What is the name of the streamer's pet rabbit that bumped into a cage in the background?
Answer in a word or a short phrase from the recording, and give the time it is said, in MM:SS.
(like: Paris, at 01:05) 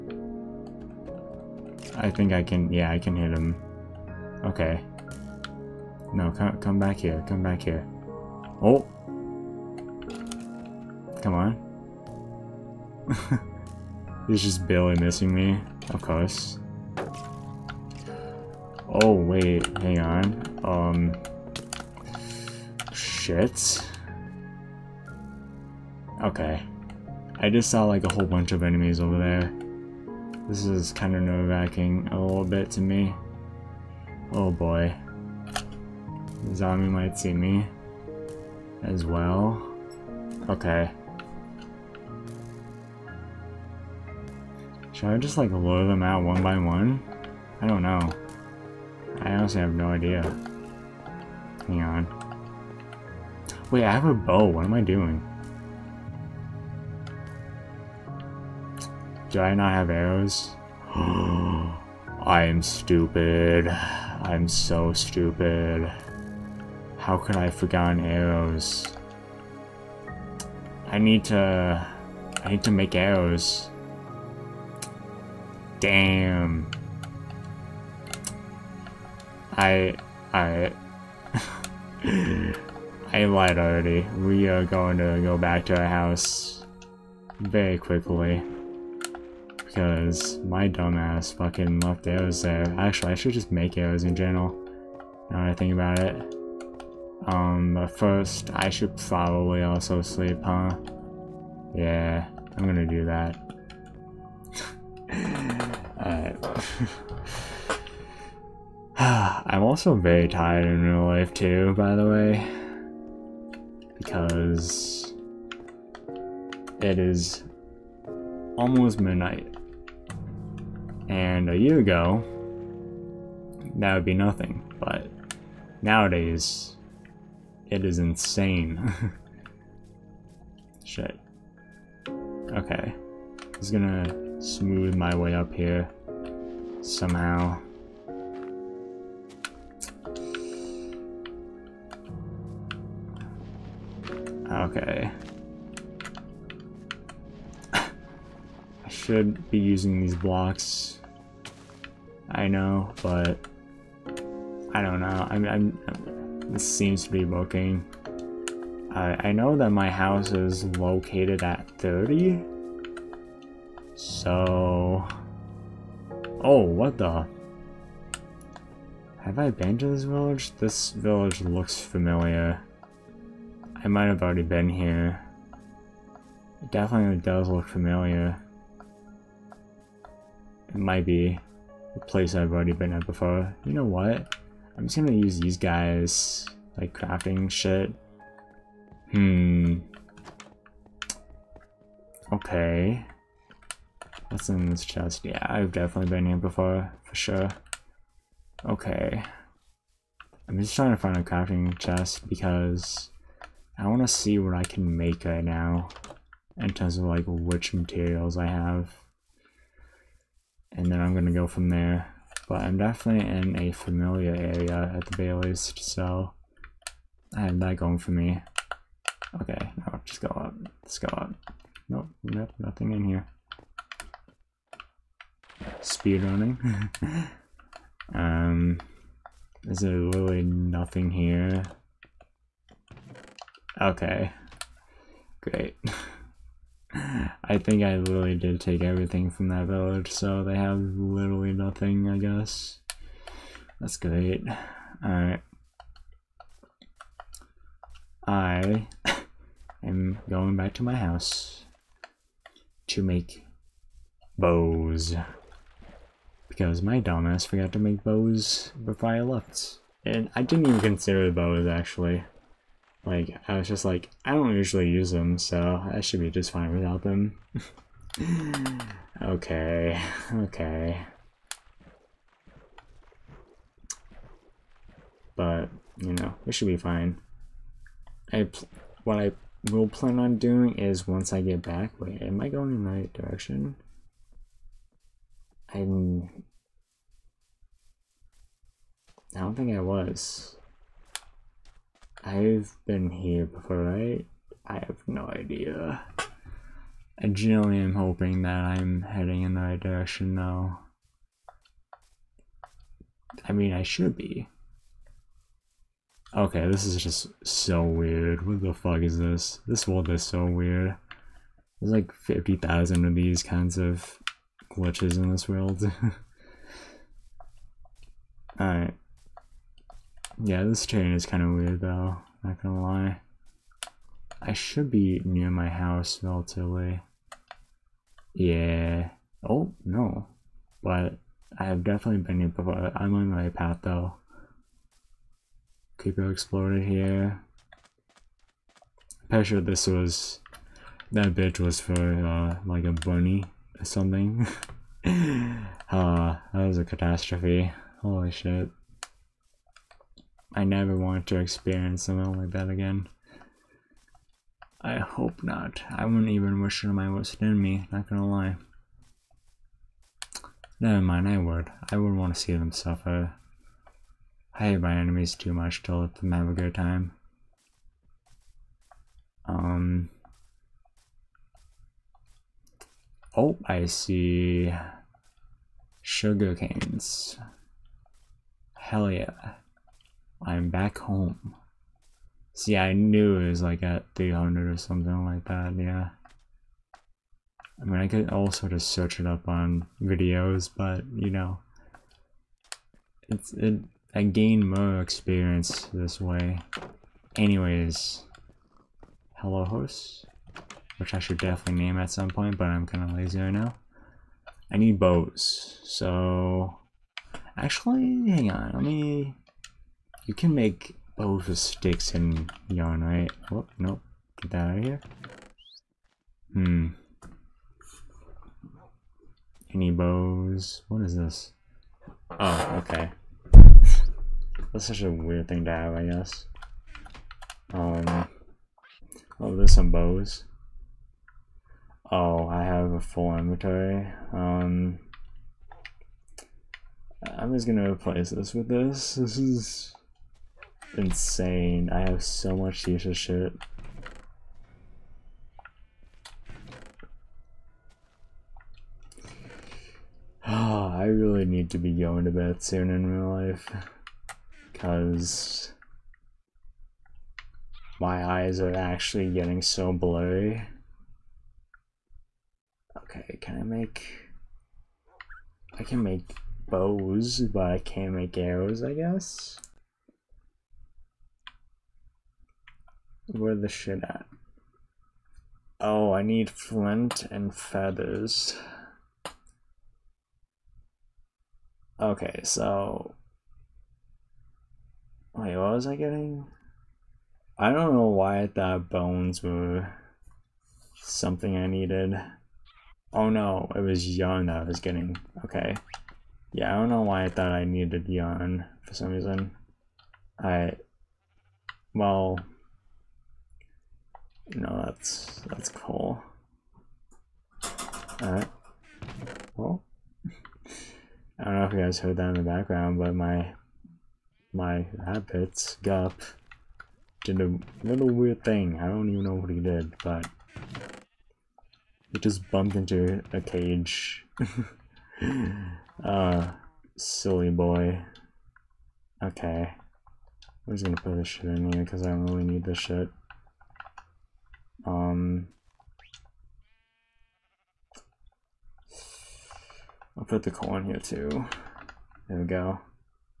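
Gup, at 08:35.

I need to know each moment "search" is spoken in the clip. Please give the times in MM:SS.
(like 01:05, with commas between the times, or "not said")
06:28.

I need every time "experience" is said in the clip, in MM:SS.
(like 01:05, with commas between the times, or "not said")
05:51, 06:35.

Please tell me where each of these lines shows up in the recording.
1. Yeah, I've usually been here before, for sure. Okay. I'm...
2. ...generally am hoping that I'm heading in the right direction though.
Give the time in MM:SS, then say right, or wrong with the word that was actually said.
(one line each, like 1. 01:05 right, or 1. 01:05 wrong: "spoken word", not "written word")
1. 03:15 wrong: "definitely", not "usually"
2. 04:57 right.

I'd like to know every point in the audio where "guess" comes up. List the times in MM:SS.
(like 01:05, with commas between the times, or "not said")
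04:02, 07:06, 07:48.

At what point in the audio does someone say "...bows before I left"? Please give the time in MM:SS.
04:18.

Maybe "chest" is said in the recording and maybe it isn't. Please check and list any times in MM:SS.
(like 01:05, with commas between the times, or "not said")
03:14, 03:21.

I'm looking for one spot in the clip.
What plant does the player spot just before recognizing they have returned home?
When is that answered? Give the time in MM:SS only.
06:16.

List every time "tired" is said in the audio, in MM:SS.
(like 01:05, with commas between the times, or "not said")
01:50.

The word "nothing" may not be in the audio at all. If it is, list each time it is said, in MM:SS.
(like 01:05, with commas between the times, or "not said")
02:04, 03:42, 03:50, 04:01.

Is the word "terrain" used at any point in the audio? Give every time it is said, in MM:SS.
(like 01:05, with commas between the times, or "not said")
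05:20.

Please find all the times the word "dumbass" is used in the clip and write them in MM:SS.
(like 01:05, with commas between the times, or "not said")
01:30, 04:16.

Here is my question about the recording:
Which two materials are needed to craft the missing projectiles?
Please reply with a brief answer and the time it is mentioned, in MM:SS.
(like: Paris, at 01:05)
Flint and feathers, at 07:56.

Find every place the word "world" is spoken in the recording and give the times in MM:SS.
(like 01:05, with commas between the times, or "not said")
05:09, 05:15.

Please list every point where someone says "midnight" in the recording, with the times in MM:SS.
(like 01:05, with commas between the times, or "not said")
01:59.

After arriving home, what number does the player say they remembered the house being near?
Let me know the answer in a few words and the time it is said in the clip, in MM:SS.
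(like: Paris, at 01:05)
300, at 06:23.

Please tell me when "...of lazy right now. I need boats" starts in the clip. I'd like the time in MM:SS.
06:43.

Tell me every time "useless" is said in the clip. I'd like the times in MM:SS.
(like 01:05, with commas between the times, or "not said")
07:22.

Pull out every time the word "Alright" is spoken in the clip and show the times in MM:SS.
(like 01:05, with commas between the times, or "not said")
01:46, 04:05, 05:18, 08:28.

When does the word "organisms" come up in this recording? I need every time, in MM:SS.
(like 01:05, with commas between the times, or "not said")
not said.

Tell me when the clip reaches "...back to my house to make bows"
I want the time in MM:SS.
04:10.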